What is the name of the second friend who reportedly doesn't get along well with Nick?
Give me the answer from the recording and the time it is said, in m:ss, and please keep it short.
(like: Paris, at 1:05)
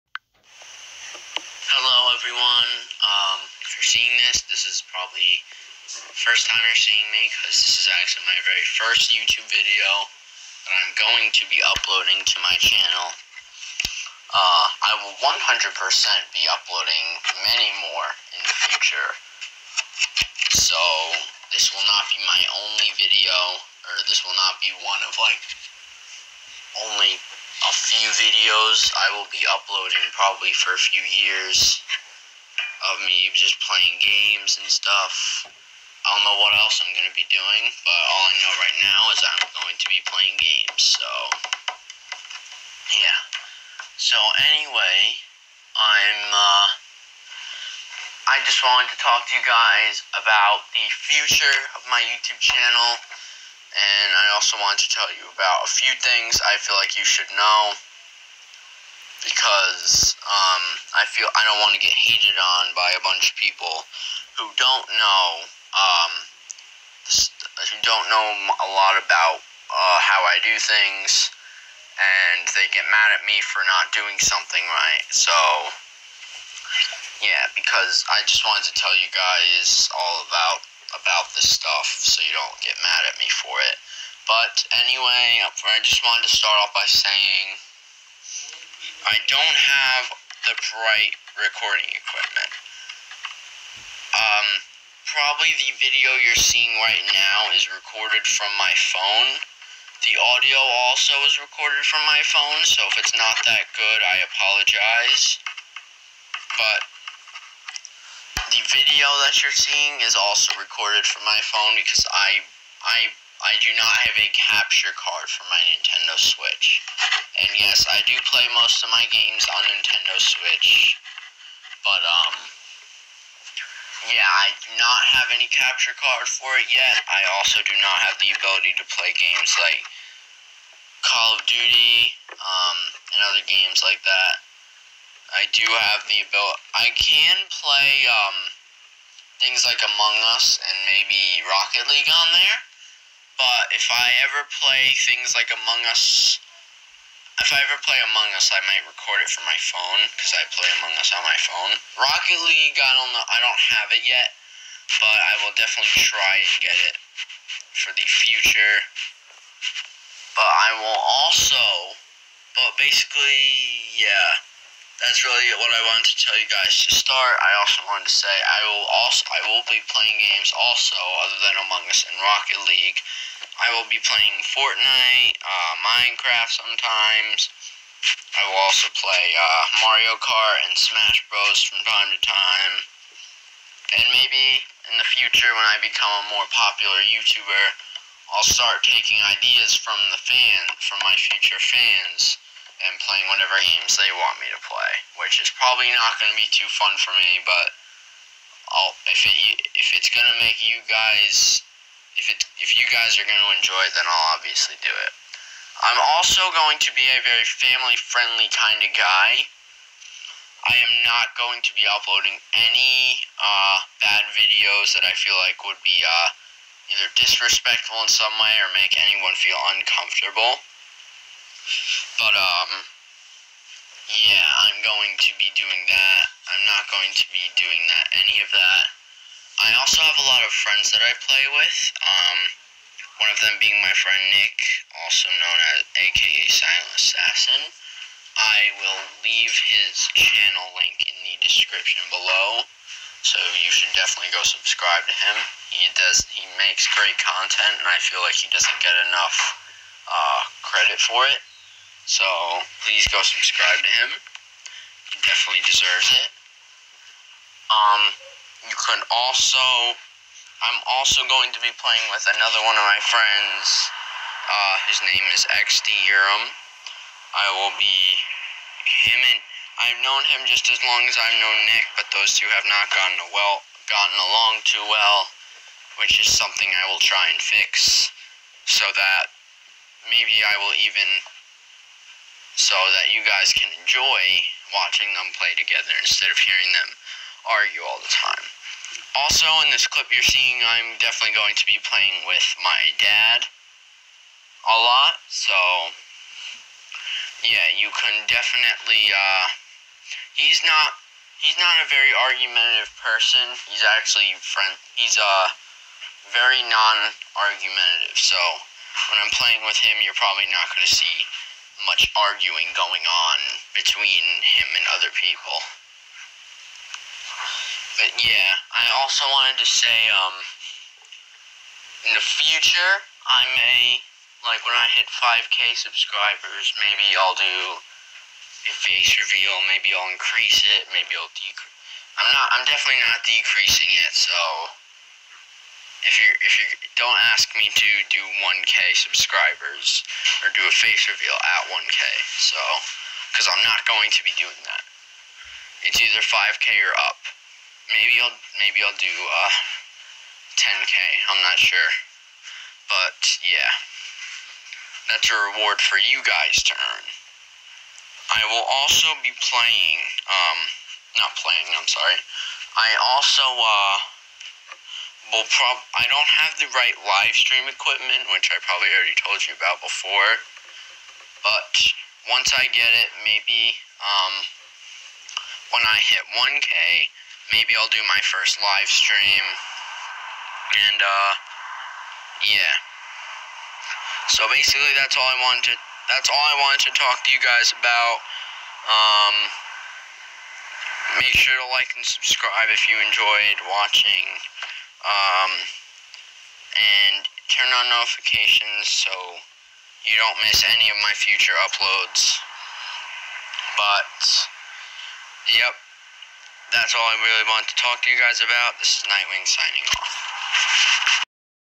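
XD Urim, at 4:25.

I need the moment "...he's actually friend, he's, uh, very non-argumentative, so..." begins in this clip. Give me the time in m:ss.
5:03.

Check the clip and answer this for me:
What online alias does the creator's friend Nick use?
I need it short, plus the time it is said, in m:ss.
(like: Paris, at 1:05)
Silent Assassin, at 3:56.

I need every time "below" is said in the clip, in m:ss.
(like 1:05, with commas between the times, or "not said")
4:02.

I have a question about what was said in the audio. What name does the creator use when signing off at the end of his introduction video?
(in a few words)
Knightwing.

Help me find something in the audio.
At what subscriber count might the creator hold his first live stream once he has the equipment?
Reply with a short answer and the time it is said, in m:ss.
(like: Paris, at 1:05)
1K, at 6:15.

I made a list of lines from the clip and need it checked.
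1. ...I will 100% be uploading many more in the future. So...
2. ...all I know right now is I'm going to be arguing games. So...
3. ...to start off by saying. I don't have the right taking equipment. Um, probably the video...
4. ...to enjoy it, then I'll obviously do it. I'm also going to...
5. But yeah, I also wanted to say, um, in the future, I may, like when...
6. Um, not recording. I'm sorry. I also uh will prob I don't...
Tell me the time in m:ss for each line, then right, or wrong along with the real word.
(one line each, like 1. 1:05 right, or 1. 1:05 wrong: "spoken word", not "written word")
1. 0:14 right
2. 0:38 wrong: "playing", not "arguing"
3. 1:26 wrong: "recording", not "taking"
4. 3:23 right
5. 5:17 right
6. 6:00 wrong: "playing", not "recording".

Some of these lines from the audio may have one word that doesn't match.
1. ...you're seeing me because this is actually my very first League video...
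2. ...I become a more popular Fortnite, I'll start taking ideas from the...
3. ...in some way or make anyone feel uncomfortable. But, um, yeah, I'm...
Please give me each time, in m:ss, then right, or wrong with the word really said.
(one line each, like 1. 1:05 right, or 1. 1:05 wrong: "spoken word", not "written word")
1. 0:06 wrong: "YouTube", not "League"
2. 3:05 wrong: "YouTuber", not "Fortnite"
3. 3:38 right.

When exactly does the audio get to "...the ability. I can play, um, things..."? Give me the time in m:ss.
2:16.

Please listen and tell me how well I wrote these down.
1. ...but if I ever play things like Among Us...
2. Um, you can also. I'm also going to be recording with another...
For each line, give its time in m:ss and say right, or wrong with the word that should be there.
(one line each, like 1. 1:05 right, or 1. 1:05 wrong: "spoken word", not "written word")
1. 2:23 right
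2. 4:17 wrong: "playing", not "recording".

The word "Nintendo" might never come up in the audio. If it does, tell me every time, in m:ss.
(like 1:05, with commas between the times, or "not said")
1:55, 1:59.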